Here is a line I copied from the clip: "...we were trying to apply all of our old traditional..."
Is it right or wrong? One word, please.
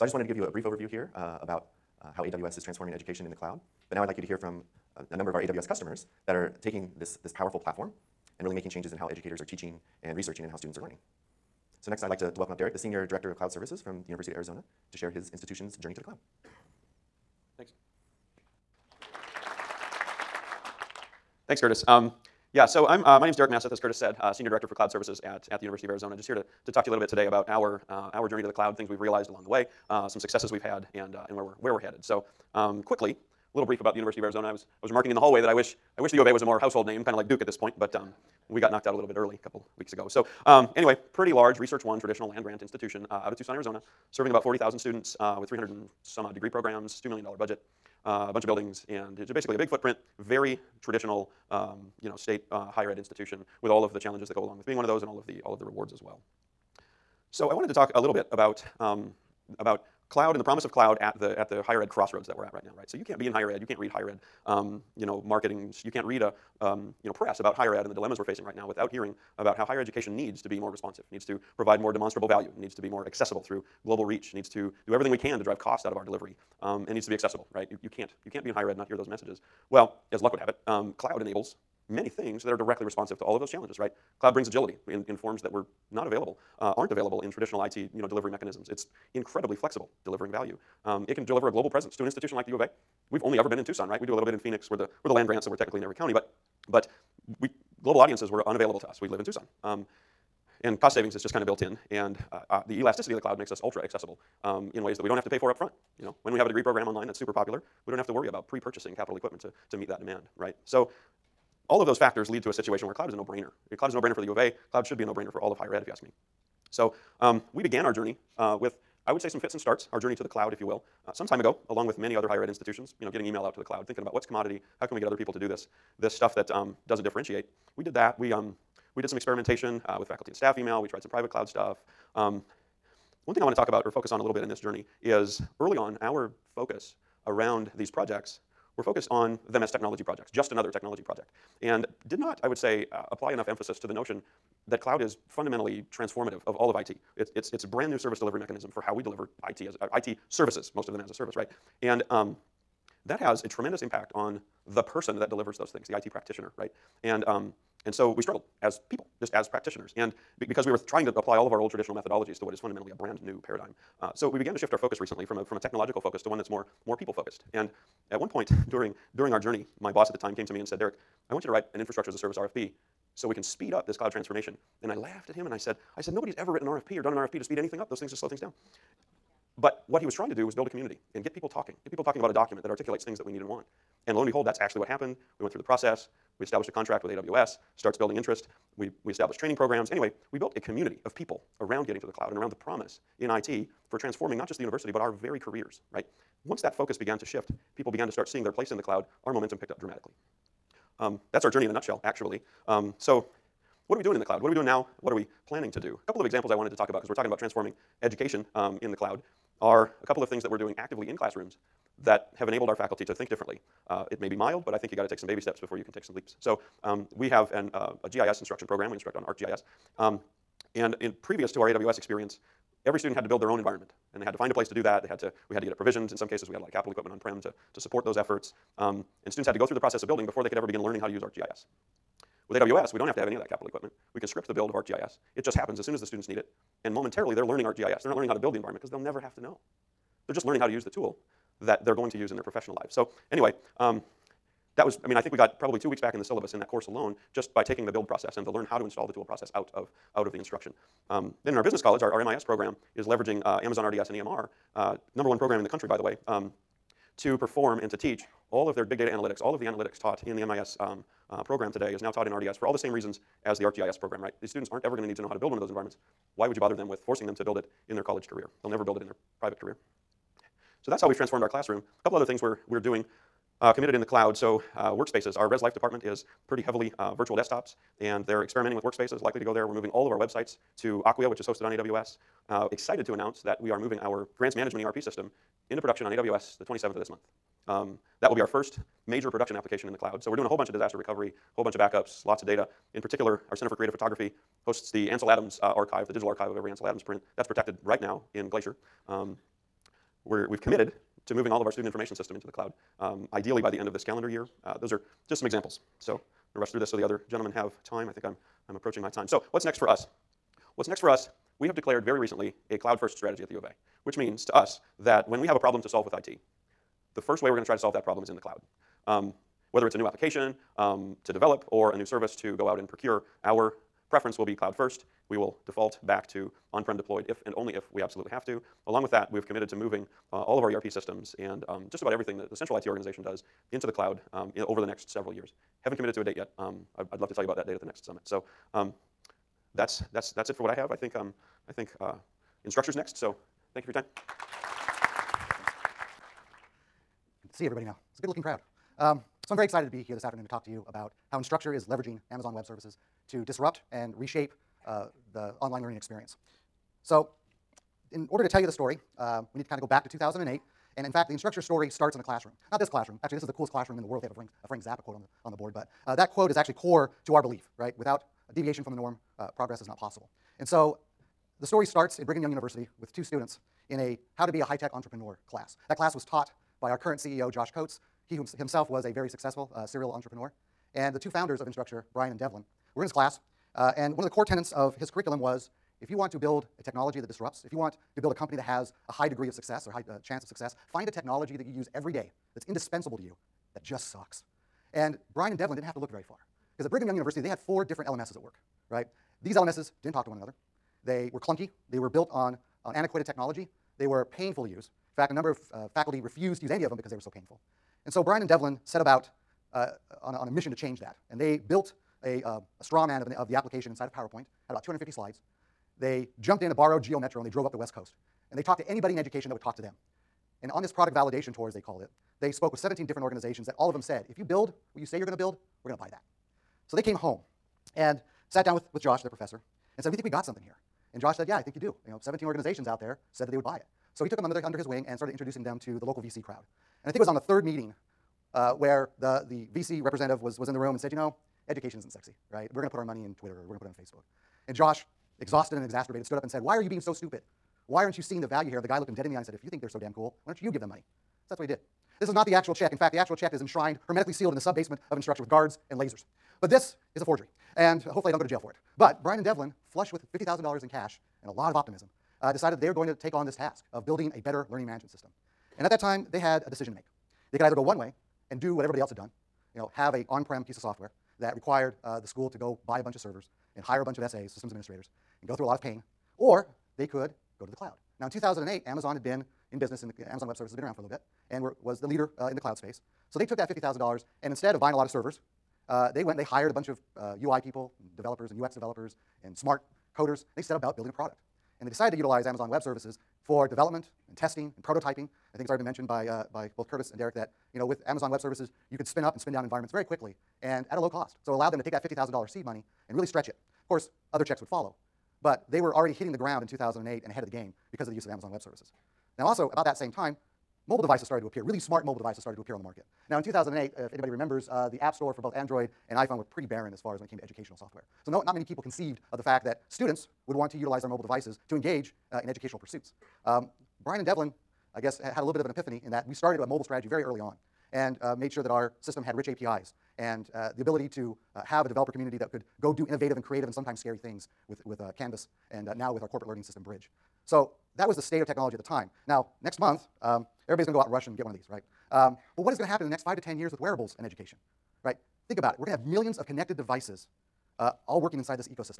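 right.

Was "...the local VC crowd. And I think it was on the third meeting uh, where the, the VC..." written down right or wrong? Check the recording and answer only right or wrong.
right.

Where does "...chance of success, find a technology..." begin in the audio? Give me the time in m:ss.
6:30.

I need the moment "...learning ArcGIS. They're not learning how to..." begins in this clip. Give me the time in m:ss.
3:57.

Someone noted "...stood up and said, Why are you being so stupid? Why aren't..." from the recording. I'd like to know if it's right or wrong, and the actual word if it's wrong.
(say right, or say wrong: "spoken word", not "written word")
right.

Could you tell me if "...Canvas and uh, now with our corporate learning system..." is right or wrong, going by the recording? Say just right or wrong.
right.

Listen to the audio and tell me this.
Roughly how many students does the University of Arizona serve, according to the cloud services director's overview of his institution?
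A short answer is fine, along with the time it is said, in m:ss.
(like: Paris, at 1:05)
40,000, at 0:44.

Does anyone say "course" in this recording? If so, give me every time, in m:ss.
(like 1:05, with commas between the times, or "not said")
4:06, 8:23.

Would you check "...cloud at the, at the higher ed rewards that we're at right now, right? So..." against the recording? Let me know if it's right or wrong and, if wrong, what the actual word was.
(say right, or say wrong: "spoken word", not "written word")
wrong: "crossroads", not "rewards".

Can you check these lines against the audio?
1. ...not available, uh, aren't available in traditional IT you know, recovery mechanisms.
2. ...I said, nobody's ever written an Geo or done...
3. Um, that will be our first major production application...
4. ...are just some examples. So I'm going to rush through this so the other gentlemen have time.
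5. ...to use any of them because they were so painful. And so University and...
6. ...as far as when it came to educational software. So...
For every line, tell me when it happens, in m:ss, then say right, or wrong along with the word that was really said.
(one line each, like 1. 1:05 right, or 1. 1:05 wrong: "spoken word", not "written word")
1. 1:25 wrong: "delivery", not "recovery"
2. 2:55 wrong: "RFP", not "Geo"
3. 4:47 right
4. 5:04 right
5. 6:46 wrong: "Brian", not "University"
6. 8:36 right.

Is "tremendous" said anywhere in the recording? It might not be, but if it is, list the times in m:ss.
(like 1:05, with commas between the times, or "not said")
2:33.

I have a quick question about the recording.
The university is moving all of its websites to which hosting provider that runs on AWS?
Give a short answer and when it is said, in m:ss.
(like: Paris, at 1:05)
Acquia, at 4:41.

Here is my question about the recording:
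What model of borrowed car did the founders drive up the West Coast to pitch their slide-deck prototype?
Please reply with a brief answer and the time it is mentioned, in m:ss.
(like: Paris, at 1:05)
Geo Metro, at 6:57.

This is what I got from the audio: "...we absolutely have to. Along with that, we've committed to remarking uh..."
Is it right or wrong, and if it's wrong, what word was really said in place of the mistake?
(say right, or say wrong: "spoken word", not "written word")
wrong: "moving", not "remarking".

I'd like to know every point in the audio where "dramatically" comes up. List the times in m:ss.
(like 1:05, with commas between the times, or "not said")
3:19.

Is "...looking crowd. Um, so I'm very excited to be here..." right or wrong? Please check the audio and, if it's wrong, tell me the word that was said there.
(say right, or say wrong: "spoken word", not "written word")
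right.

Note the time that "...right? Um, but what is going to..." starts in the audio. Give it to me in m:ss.
9:01.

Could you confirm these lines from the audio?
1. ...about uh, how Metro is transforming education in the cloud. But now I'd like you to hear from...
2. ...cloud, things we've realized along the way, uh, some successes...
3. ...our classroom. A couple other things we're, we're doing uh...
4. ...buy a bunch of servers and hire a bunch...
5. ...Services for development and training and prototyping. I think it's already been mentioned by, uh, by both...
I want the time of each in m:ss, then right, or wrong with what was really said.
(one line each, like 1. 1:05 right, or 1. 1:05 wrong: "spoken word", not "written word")
1. 0:01 wrong: "AWS", not "Metro"
2. 0:28 right
3. 4:31 right
4. 7:52 right
5. 8:12 wrong: "testing", not "training".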